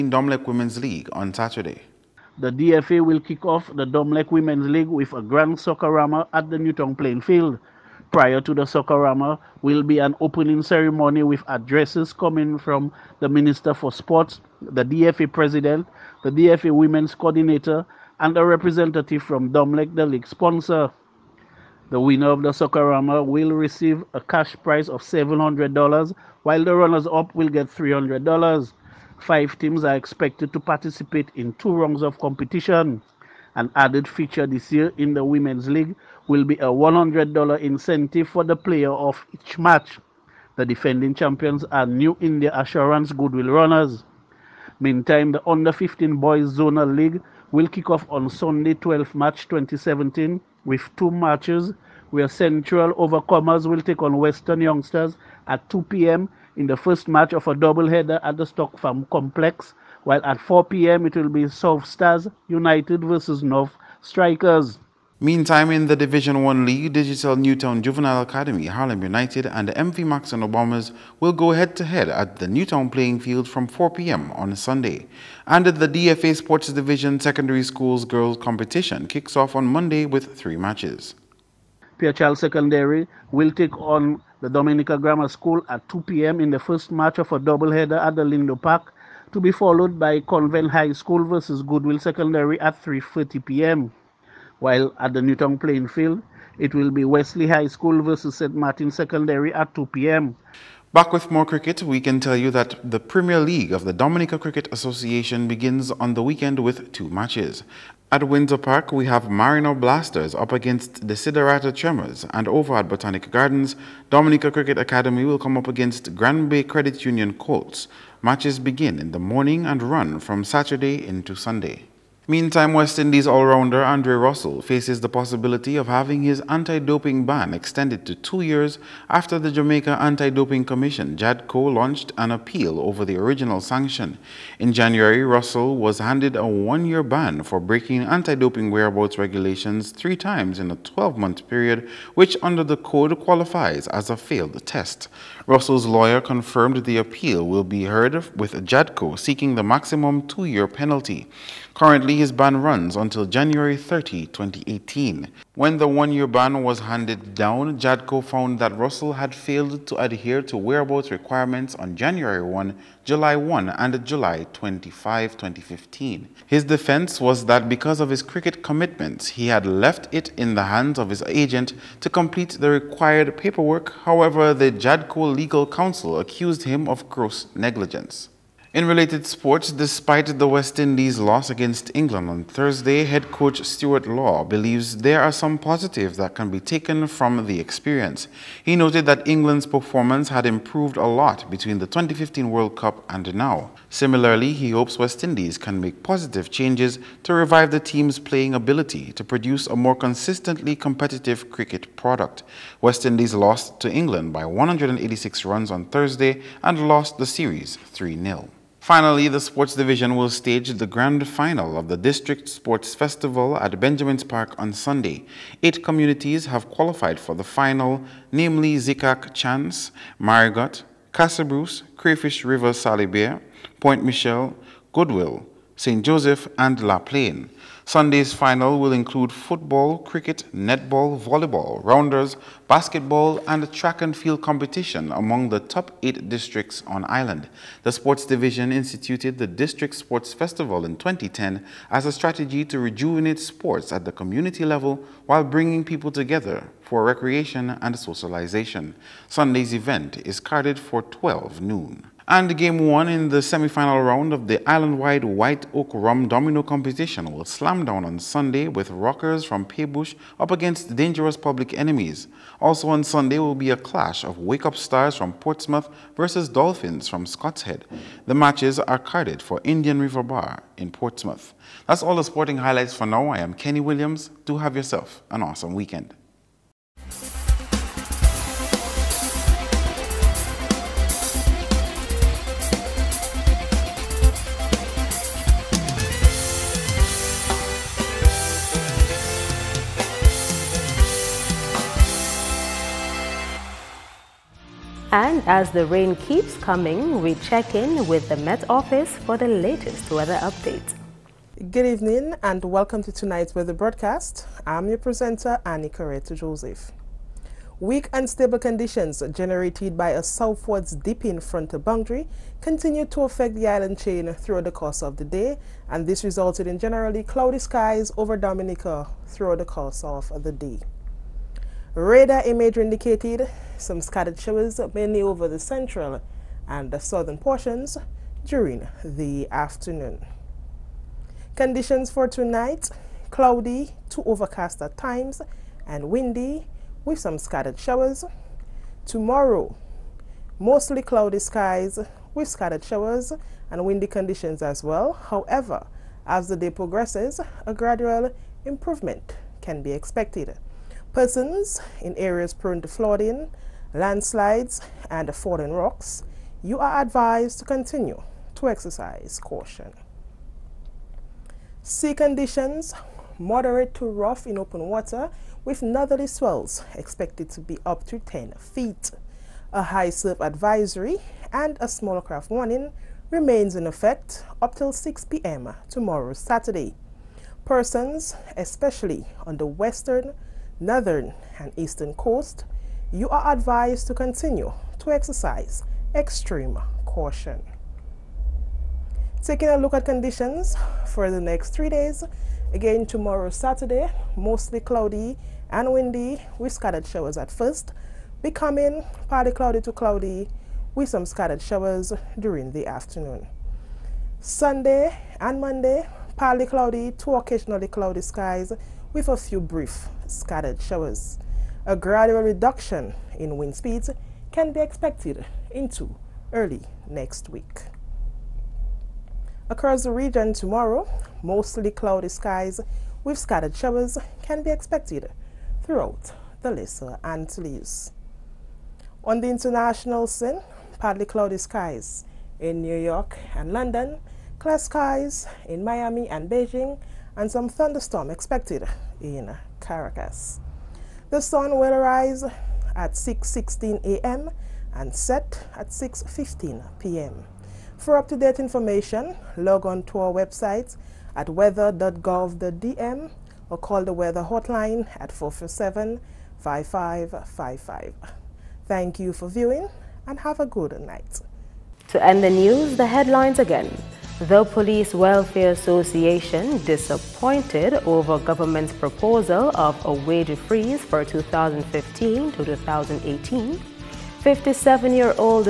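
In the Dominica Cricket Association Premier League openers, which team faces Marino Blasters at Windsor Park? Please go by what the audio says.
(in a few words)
Desiderata Tremors.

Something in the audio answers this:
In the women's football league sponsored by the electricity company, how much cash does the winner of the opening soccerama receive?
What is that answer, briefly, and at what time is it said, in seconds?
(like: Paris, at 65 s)
$700, at 25 s.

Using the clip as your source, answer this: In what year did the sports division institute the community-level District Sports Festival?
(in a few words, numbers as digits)
2010.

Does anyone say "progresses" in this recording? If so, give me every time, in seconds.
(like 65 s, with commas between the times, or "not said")
346 s.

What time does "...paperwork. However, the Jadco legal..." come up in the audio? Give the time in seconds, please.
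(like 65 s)
173 s.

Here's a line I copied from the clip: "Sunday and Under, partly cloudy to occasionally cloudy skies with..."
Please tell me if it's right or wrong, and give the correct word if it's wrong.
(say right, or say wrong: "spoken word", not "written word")
wrong: "Monday", not "Under".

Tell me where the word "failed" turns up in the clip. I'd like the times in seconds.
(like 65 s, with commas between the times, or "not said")
144 s, 159 s.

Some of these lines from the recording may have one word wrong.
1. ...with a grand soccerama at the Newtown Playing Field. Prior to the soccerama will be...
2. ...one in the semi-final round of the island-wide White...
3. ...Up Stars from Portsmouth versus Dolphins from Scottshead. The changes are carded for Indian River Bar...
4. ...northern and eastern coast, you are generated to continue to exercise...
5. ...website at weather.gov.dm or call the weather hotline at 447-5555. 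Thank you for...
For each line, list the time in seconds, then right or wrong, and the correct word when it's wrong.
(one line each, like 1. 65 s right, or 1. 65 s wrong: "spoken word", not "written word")
1. 4 s right
2. 252 s right
3. 264 s wrong: "matches", not "changes"
4. 380 s wrong: "advised", not "generated"
5. 450 s right.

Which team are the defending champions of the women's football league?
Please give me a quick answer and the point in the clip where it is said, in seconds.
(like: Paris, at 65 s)
New India Assurance Goodwill Runners, at 41 s.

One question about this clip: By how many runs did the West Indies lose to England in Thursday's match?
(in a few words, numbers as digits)
186.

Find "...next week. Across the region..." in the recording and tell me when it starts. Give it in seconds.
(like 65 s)
417 s.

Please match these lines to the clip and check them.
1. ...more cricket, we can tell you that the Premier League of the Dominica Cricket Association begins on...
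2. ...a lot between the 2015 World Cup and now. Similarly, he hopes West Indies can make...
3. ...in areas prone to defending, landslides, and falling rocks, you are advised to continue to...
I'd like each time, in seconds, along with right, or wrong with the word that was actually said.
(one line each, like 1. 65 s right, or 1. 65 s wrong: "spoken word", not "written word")
1. 101 s right
2. 190 s right
3. 352 s wrong: "flooding", not "defending".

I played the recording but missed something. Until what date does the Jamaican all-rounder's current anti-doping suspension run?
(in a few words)
January 30, 2018.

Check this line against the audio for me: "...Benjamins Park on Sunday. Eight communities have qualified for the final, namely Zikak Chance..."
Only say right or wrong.
right.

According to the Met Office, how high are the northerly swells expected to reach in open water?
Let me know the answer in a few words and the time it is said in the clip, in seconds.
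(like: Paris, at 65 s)
10 feet, at 368 s.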